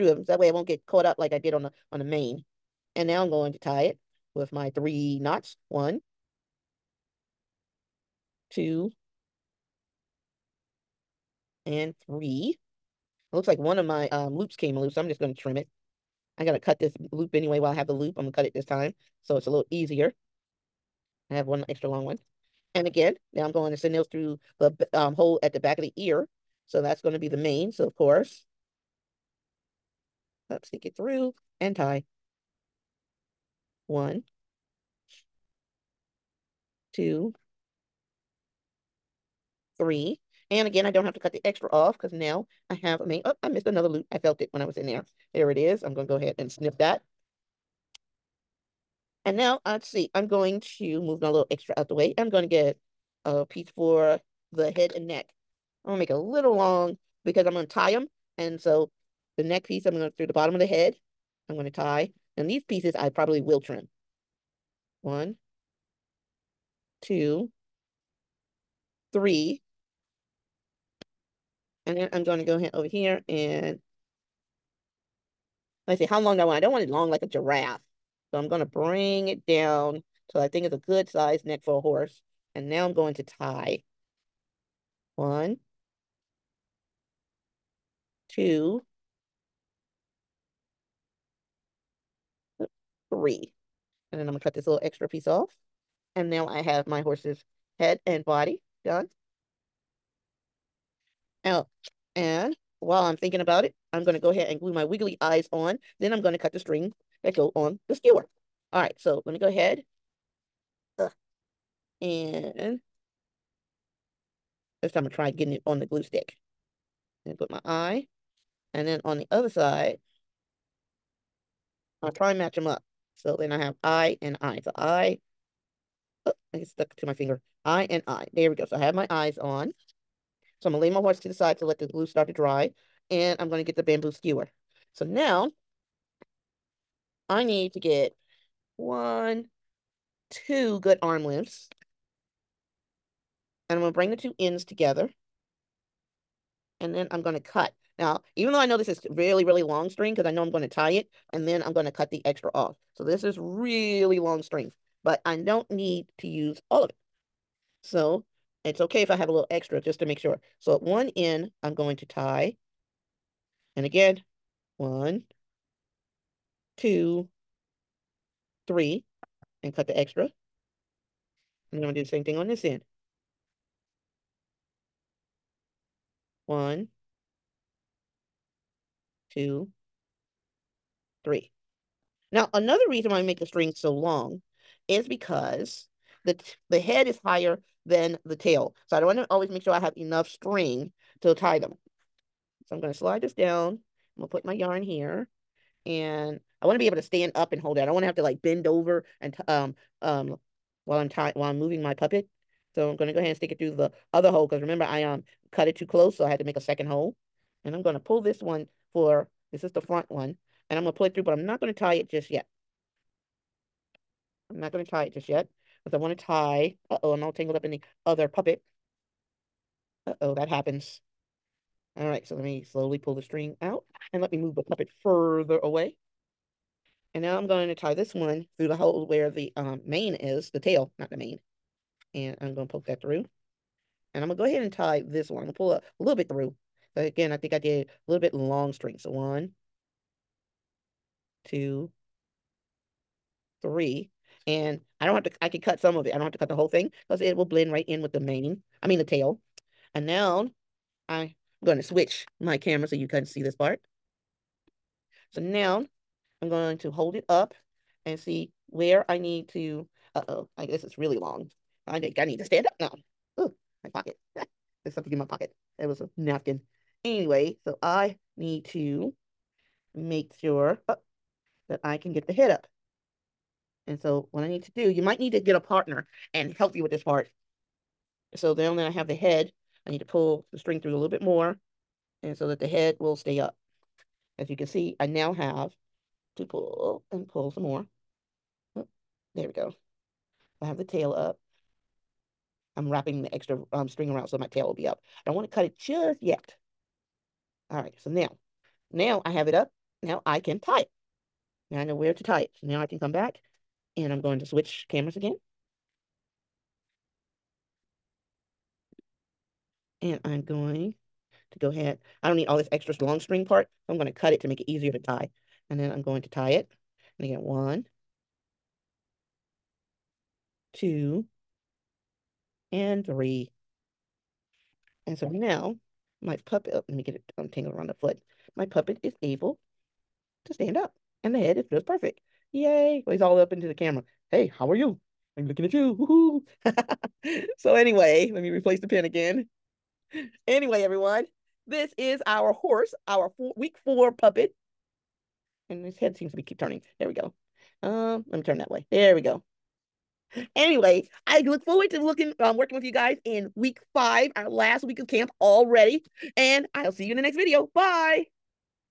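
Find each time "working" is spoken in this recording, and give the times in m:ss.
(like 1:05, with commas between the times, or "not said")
5:52.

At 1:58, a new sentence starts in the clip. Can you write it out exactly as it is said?
And then on the other side, I'll try and match them up.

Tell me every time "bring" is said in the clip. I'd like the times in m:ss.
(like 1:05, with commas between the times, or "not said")
1:18, 2:23.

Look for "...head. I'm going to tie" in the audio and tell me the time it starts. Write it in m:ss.
1:00.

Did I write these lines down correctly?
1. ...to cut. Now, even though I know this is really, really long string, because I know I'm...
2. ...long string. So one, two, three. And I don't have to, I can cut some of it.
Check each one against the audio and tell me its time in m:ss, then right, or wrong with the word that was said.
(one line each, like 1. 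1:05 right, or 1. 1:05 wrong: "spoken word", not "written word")
1. 2:27 right
2. 3:58 right.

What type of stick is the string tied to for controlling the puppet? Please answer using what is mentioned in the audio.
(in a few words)
Bamboo skewer.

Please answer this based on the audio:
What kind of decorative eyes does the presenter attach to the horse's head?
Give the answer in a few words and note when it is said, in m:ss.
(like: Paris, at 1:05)
Wiggly eyes, at 1:44.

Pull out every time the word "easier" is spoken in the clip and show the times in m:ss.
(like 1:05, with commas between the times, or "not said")
0:19, 5:14.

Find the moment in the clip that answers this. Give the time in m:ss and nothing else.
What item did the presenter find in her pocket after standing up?
4:26.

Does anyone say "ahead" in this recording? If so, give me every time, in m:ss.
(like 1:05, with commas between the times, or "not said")
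0:46, 1:12, 1:44, 1:49, 3:23, 3:54, 5:11.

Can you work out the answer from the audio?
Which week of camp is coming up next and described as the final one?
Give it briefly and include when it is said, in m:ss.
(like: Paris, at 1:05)
Week 5, at 5:53.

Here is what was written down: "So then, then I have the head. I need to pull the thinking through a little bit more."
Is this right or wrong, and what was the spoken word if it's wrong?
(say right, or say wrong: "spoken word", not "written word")
wrong: "string", not "thinking".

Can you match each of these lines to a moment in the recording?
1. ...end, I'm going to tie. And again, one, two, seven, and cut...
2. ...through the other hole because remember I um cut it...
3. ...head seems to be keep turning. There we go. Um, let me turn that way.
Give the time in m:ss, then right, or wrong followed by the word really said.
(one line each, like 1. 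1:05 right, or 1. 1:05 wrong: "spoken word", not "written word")
1. 2:41 wrong: "three", not "seven"
2. 3:23 right
3. 5:45 right.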